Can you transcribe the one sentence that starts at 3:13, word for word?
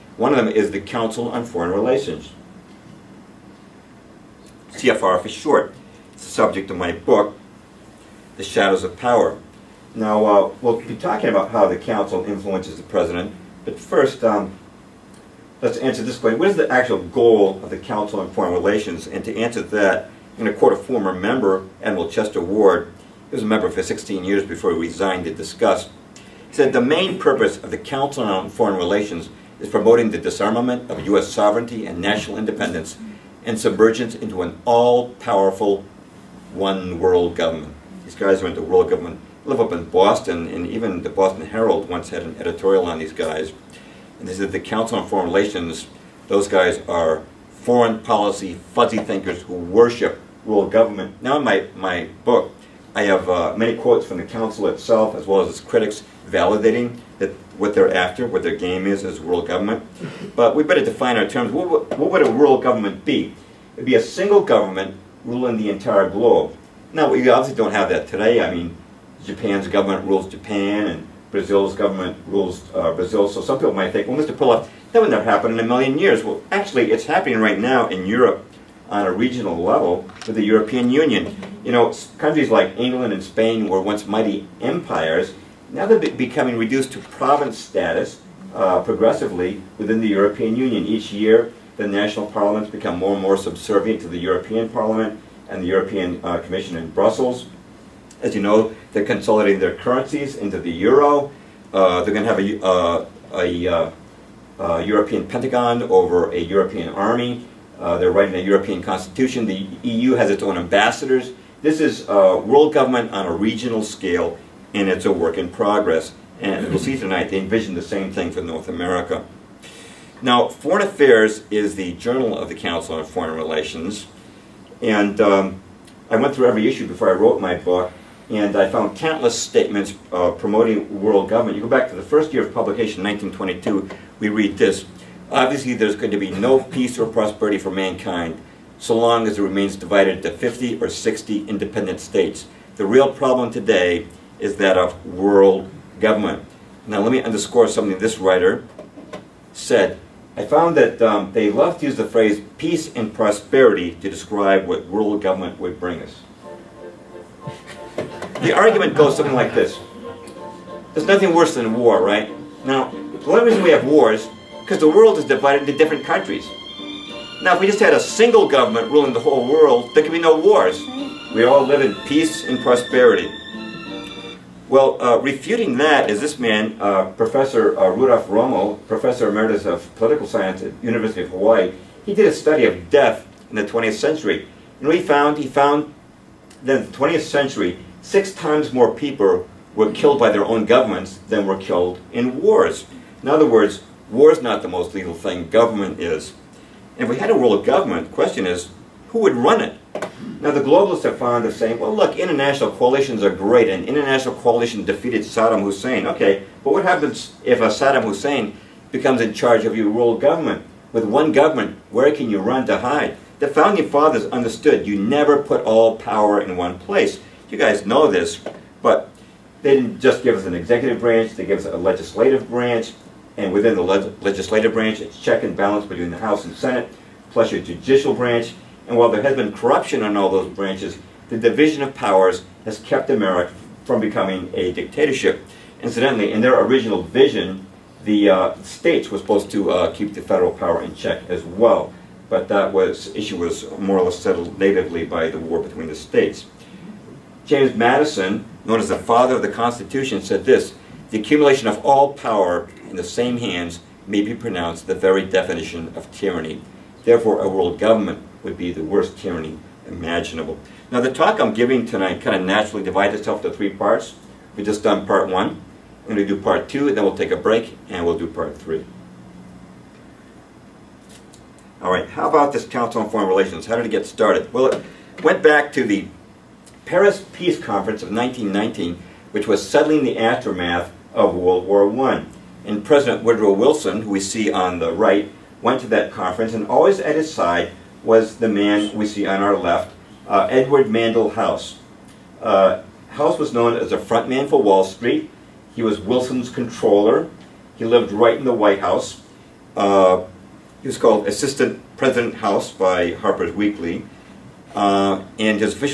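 In other words, War is not the most lethal thing, government is.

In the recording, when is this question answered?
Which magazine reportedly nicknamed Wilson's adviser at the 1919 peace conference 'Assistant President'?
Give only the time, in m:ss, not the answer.
5:03.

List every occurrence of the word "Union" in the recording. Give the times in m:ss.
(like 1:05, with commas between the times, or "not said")
1:20, 1:30.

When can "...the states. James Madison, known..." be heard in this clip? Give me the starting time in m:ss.
4:05.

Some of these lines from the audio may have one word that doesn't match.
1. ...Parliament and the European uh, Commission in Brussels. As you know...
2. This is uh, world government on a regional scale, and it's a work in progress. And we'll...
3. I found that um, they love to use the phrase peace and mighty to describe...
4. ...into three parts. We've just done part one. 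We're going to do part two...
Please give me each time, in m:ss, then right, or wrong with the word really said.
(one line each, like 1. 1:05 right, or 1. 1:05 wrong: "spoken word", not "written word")
1. 1:34 right
2. 1:51 right
3. 2:30 wrong: "prosperity", not "mighty"
4. 4:23 right.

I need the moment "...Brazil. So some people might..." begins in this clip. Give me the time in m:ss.
1:12.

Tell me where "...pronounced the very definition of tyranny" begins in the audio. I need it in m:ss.
4:14.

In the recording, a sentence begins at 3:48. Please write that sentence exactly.
And while there has been corruption on all those branches, the division of powers has kept America from becoming a dictatorship.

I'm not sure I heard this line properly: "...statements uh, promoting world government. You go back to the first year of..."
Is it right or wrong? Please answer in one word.
right.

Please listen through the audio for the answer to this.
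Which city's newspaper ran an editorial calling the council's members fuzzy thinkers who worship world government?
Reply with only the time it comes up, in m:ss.
0:41.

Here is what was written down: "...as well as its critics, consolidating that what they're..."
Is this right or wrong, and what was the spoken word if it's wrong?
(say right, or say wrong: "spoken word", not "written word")
wrong: "validating", not "consolidating".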